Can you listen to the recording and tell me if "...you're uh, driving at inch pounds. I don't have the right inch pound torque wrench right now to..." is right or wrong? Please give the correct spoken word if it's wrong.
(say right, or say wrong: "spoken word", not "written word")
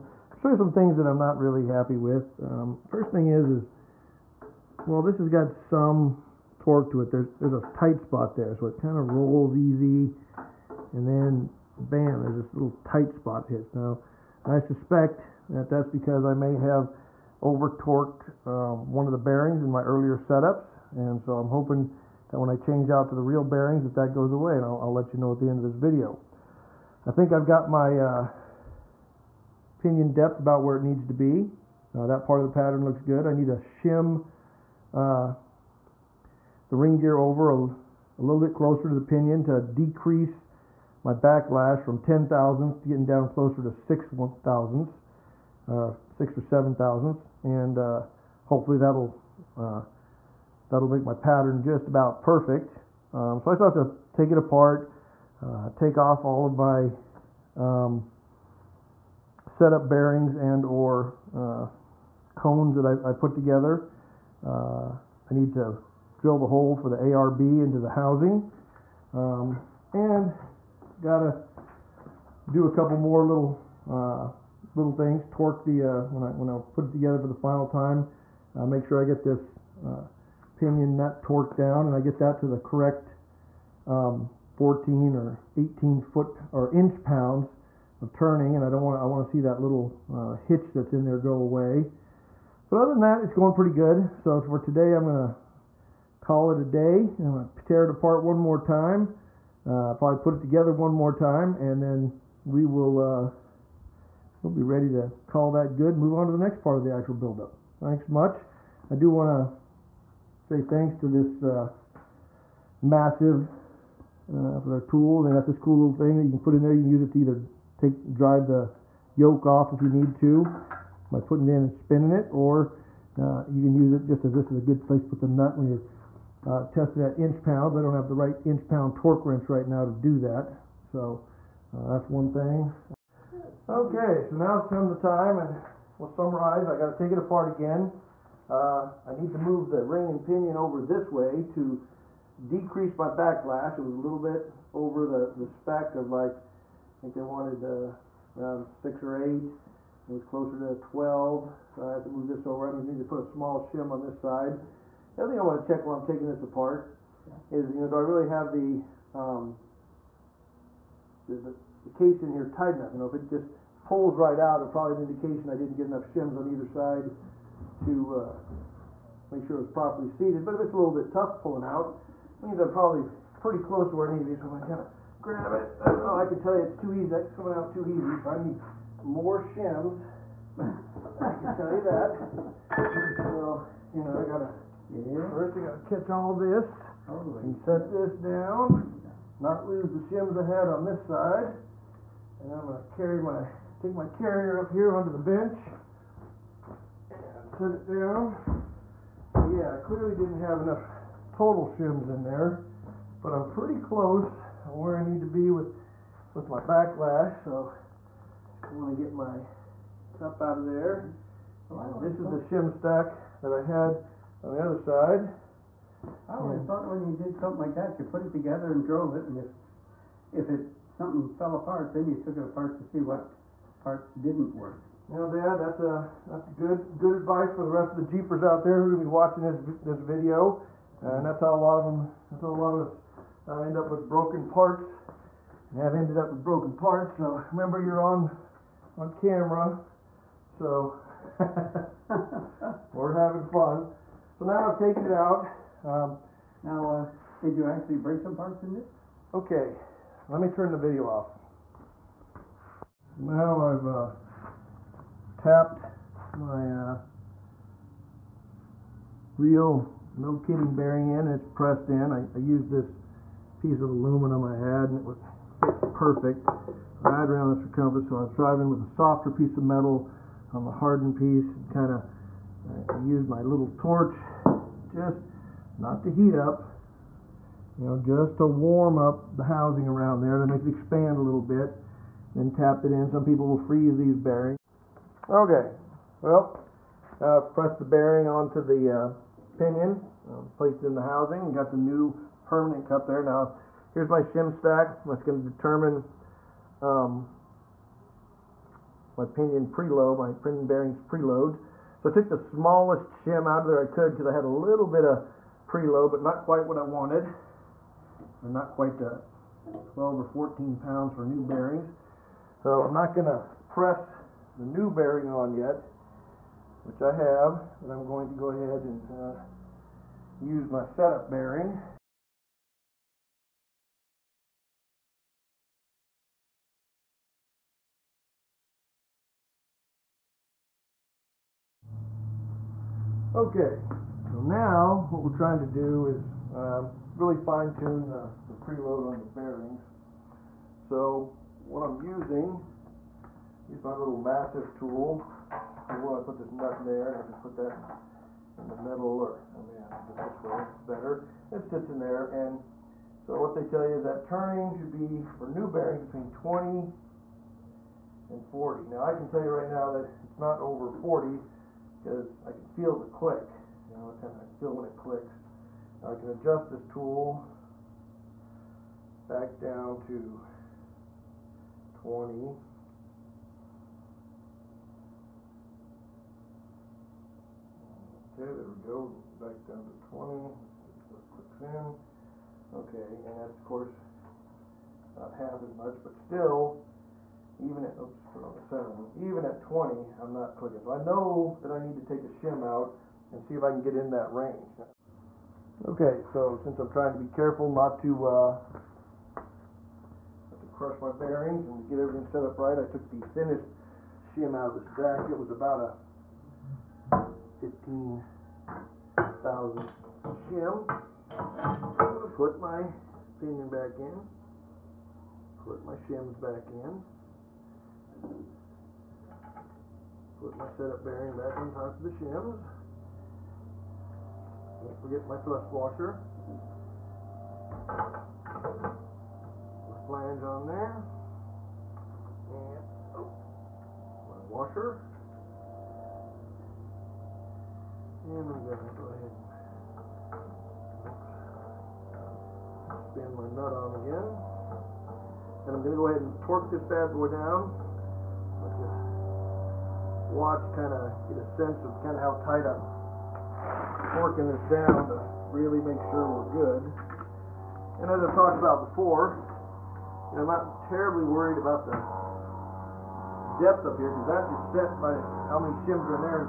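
wrong: "testing", not "driving".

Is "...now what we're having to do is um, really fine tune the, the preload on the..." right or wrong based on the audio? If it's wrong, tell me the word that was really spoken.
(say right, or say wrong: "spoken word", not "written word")
wrong: "trying", not "having".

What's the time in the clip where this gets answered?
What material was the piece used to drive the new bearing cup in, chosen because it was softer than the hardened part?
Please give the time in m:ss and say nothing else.
4:23.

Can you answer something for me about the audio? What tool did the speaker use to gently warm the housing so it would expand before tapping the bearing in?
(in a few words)
Torch.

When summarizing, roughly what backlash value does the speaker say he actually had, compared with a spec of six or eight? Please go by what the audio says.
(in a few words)
12.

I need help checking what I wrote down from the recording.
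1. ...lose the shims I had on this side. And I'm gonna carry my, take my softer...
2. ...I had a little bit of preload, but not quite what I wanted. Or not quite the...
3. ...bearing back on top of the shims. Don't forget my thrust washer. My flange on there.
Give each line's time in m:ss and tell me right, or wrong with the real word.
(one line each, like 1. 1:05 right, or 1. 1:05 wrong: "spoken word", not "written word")
1. 3:09 wrong: "carrier", not "softer"
2. 5:04 right
3. 7:01 right.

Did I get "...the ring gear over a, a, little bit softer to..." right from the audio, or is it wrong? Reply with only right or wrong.
wrong.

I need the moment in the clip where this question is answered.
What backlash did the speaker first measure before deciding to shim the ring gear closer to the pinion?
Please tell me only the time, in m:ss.
0:41.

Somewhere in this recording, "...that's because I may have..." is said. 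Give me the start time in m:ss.
0:15.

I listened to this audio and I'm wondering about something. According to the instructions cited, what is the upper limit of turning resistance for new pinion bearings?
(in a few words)
40.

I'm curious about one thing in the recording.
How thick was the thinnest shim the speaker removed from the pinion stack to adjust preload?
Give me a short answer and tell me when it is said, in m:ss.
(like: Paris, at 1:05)
15, at 6:45.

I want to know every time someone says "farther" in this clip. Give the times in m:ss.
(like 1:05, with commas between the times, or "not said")
not said.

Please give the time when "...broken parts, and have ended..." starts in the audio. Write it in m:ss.
3:54.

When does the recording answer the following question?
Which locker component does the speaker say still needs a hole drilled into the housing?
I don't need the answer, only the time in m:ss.
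1:06.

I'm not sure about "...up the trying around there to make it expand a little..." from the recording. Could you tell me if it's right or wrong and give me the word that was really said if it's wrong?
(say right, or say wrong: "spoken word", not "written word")
wrong: "housing", not "trying".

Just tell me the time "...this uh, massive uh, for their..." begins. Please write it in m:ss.
1:51.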